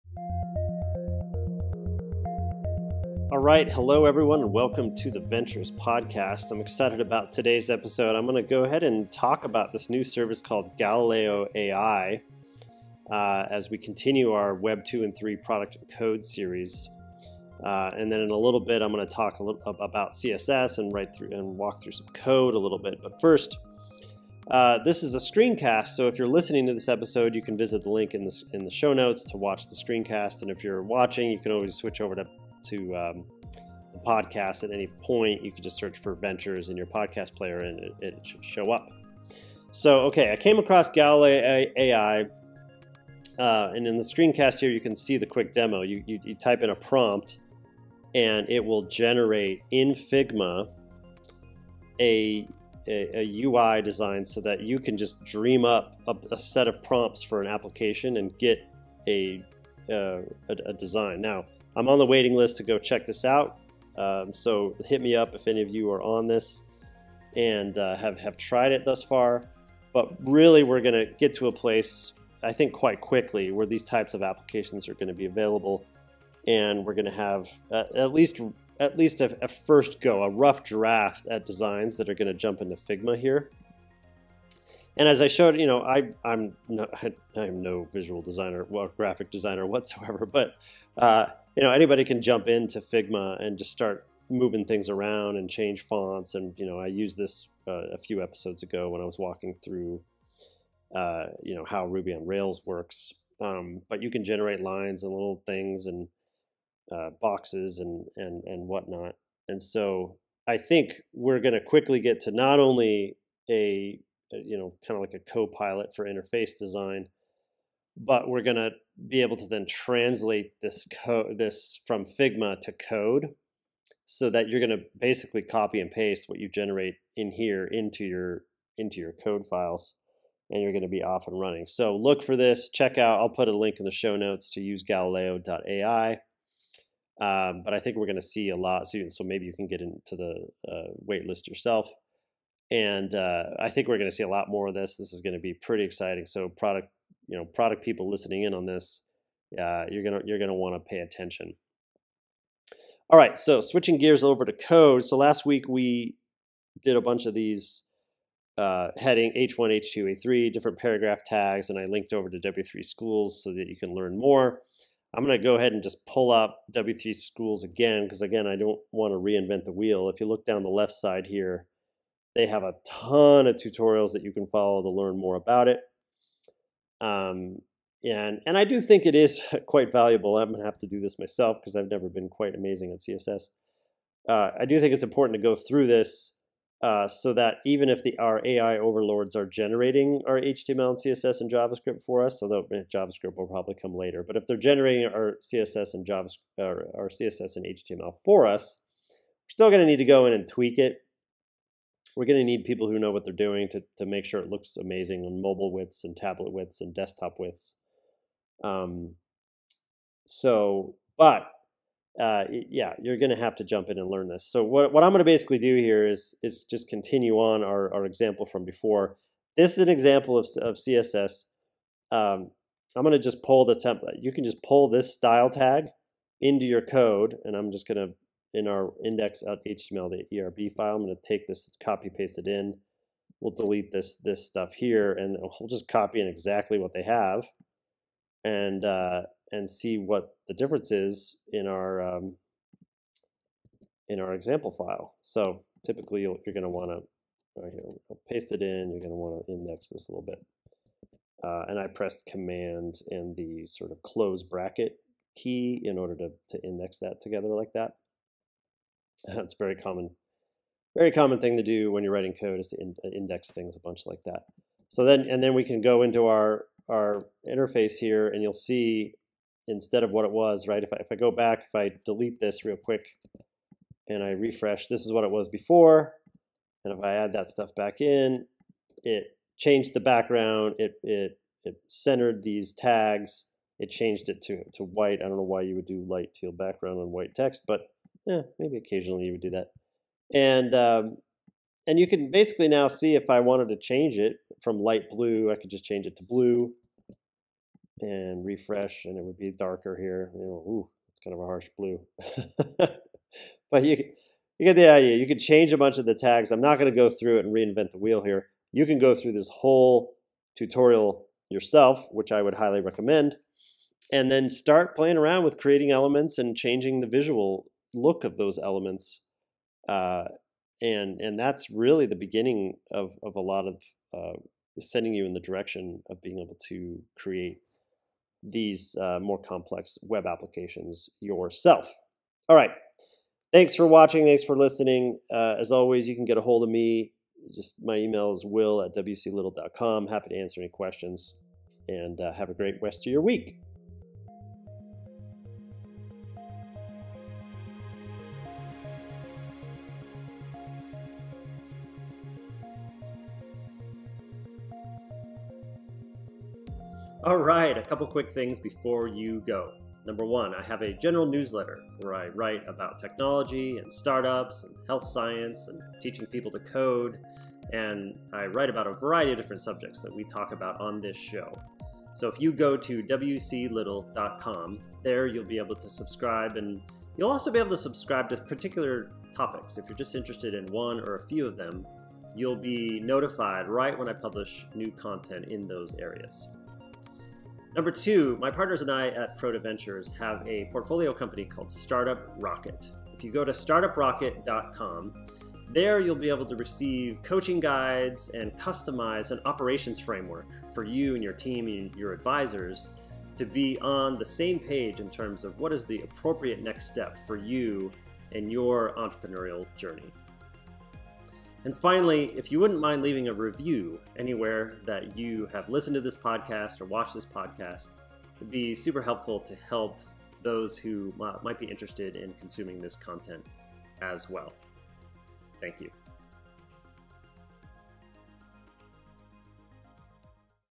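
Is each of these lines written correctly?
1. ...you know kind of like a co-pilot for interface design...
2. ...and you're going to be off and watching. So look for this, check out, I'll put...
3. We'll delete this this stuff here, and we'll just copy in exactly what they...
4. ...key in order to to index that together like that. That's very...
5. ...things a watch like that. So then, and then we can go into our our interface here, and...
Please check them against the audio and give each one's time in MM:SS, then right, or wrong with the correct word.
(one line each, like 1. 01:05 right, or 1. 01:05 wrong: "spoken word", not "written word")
1. 01:54 right
2. 02:10 wrong: "running", not "watching"
3. 03:53 right
4. 04:15 right
5. 04:23 wrong: "bunch", not "watch".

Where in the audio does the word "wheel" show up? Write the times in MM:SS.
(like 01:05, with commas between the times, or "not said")
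02:49, 05:07.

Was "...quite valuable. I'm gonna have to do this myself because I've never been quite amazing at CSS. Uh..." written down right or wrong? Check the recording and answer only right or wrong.
right.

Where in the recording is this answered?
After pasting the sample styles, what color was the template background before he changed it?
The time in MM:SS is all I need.
04:54.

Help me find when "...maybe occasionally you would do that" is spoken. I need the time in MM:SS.
04:48.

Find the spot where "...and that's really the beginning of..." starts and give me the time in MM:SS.
05:21.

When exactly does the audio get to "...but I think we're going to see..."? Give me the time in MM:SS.
02:17.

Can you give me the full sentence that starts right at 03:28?
Um, so, but uh, yeah, you're going to have to jump in and learn this.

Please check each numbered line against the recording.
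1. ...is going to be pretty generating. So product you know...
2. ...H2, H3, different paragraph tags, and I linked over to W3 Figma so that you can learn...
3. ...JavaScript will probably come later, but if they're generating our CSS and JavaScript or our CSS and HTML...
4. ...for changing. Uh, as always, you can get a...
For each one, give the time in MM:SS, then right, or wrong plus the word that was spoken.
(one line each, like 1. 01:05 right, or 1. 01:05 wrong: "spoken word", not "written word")
1. 02:25 wrong: "exciting", not "generating"
2. 02:39 wrong: "Schools", not "Figma"
3. 03:12 right
4. 05:34 wrong: "listening", not "changing".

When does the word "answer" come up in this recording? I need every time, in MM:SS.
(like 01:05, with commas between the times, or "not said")
05:40.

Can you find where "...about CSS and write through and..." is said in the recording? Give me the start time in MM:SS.
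00:19.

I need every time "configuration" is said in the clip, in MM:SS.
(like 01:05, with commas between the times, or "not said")
not said.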